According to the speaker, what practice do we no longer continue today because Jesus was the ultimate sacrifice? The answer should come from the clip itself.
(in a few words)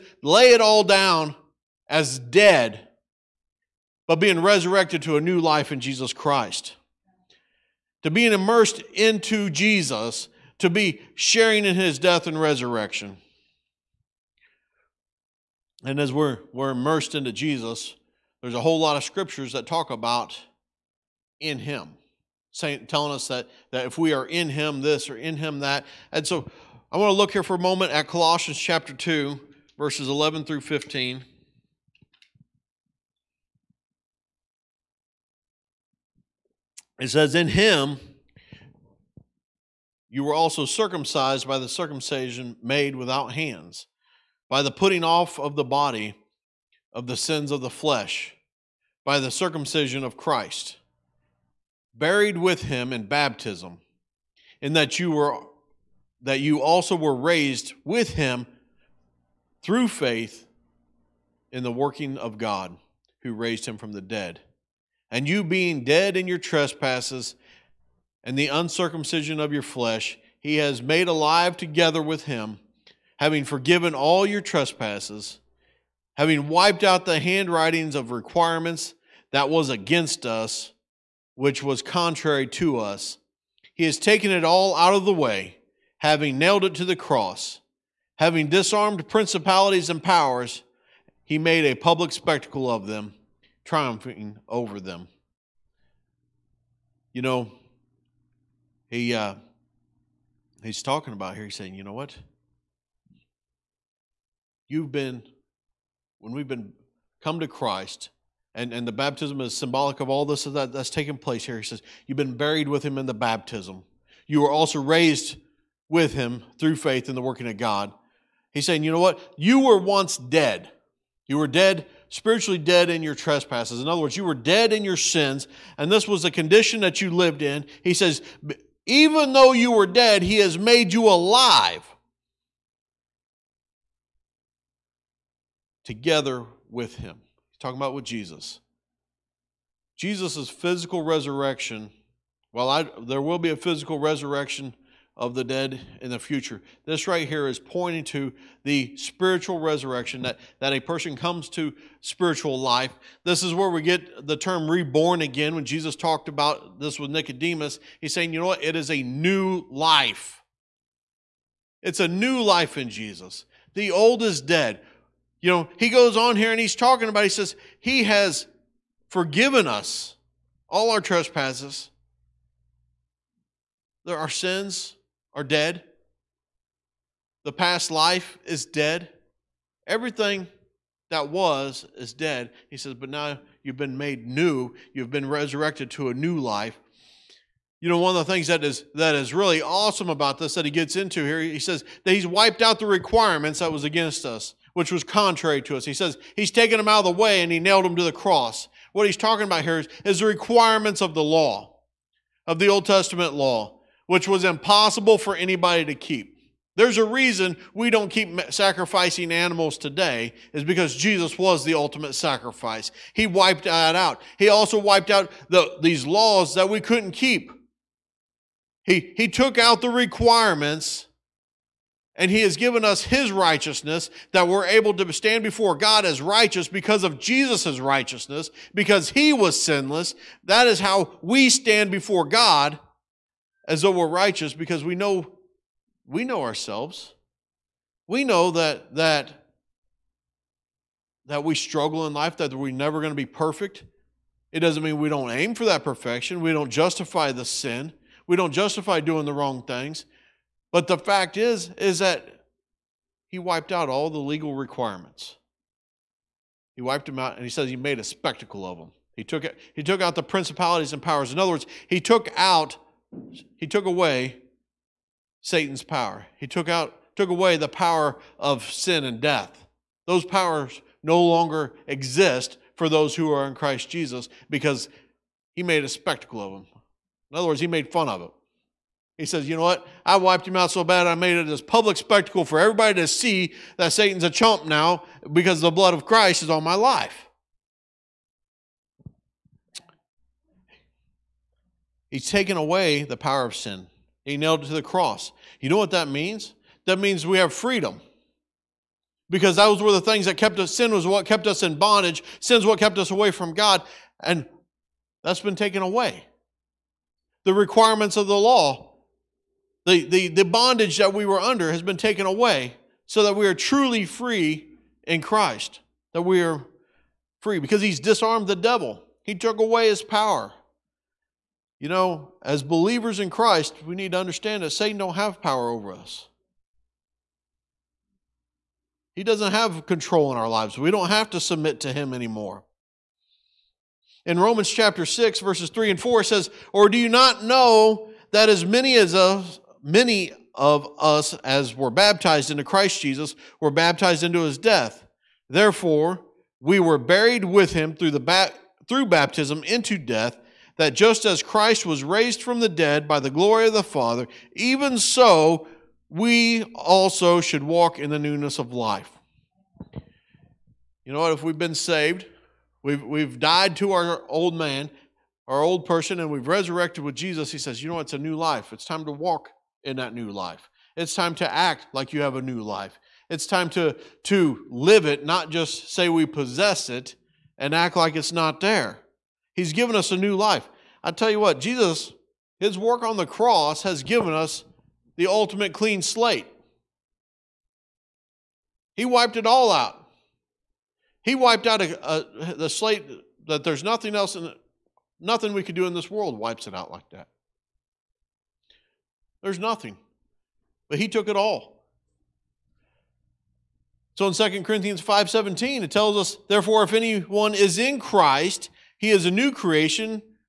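sacrificing animals.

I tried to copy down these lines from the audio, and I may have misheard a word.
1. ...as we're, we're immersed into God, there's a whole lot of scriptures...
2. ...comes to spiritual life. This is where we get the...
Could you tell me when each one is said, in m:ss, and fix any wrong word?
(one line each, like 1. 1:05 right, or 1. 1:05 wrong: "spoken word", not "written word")
1. 0:15 wrong: "Jesus", not "God"
2. 2:31 right.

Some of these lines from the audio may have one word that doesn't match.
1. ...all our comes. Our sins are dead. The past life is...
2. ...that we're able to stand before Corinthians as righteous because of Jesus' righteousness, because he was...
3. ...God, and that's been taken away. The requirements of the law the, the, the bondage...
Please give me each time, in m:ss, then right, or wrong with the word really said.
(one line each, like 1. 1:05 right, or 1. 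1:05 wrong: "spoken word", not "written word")
1. 2:50 wrong: "trespasses", not "comes"
2. 3:44 wrong: "God", not "Corinthians"
3. 5:03 right.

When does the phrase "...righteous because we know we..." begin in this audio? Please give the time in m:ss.
3:54.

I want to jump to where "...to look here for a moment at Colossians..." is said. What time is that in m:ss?
0:27.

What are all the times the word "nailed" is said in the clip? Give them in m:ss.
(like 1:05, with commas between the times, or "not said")
1:26, 3:17, 4:54.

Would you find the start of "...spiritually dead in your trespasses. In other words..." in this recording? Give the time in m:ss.
2:02.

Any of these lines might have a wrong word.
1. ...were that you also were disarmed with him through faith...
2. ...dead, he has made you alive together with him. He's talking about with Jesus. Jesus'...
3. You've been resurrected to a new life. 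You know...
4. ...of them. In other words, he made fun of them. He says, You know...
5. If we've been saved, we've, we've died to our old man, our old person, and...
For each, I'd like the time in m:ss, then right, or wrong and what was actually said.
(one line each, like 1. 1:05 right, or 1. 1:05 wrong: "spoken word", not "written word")
1. 0:55 wrong: "raised", not "disarmed"
2. 2:09 right
3. 3:04 right
4. 4:36 right
5. 6:01 right.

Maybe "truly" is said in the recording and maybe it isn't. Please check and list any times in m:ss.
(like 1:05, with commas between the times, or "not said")
5:13.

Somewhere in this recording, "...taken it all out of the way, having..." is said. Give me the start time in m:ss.
1:23.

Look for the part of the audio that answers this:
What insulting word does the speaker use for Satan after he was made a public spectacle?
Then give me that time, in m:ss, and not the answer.
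4:44.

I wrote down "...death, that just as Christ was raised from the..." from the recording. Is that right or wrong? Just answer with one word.
right.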